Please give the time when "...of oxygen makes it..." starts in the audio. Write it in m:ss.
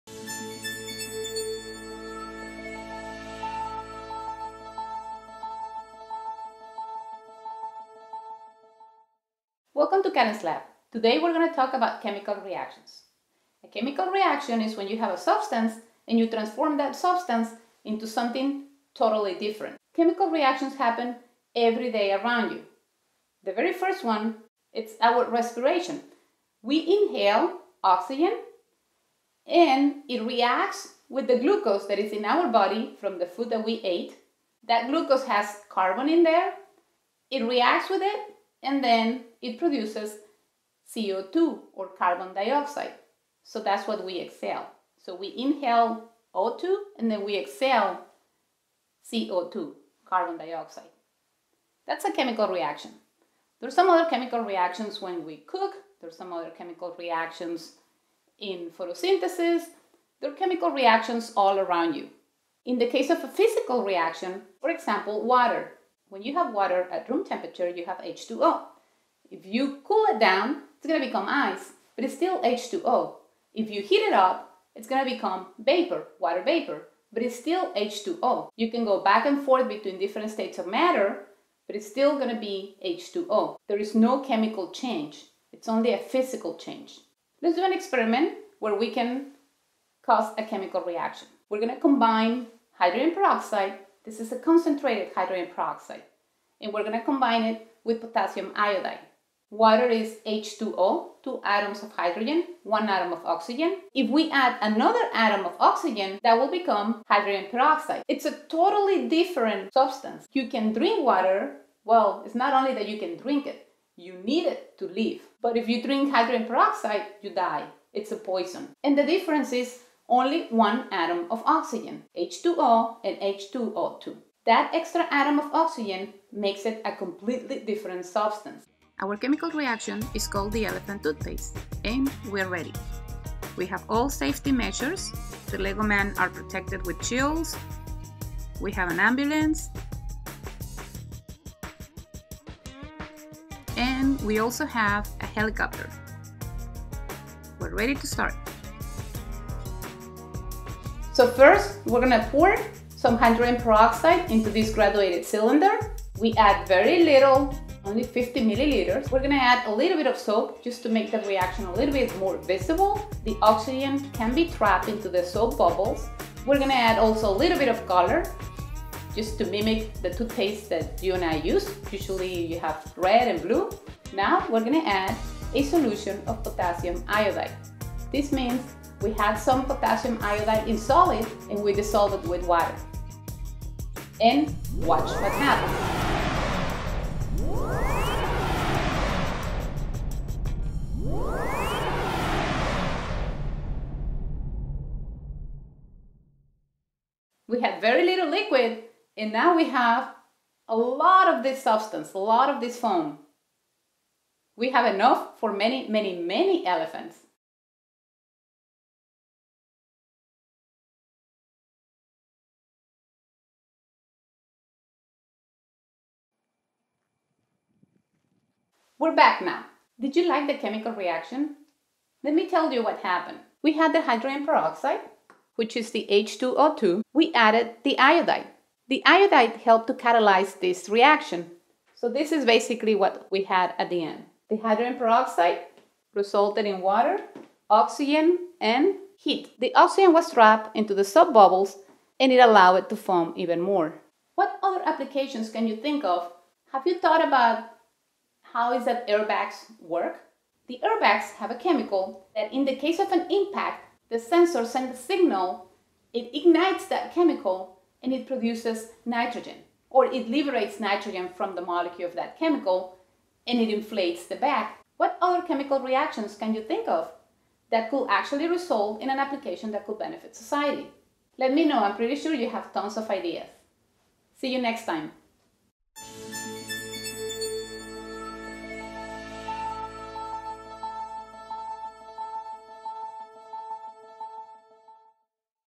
2:05.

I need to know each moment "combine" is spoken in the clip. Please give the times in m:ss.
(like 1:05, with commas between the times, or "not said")
1:31, 1:37.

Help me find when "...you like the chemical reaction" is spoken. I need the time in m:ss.
3:40.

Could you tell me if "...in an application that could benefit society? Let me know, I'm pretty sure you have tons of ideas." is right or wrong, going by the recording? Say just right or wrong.
right.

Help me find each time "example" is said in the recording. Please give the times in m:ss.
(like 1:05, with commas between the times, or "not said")
1:04.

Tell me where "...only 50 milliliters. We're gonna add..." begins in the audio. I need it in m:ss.
2:37.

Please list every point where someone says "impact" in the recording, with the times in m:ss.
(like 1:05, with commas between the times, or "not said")
4:13.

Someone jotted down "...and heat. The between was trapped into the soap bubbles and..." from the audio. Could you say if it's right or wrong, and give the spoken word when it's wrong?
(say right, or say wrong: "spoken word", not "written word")
wrong: "oxygen", not "between".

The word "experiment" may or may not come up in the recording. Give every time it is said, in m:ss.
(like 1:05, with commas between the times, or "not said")
1:27.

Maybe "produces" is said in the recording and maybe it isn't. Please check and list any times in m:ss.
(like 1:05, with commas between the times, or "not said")
0:39, 4:18.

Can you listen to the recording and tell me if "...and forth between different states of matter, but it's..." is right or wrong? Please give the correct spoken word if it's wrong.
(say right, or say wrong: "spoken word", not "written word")
right.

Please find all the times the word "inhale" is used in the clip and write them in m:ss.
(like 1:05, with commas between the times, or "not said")
0:26, 0:45.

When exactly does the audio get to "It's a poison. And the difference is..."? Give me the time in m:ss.
1:57.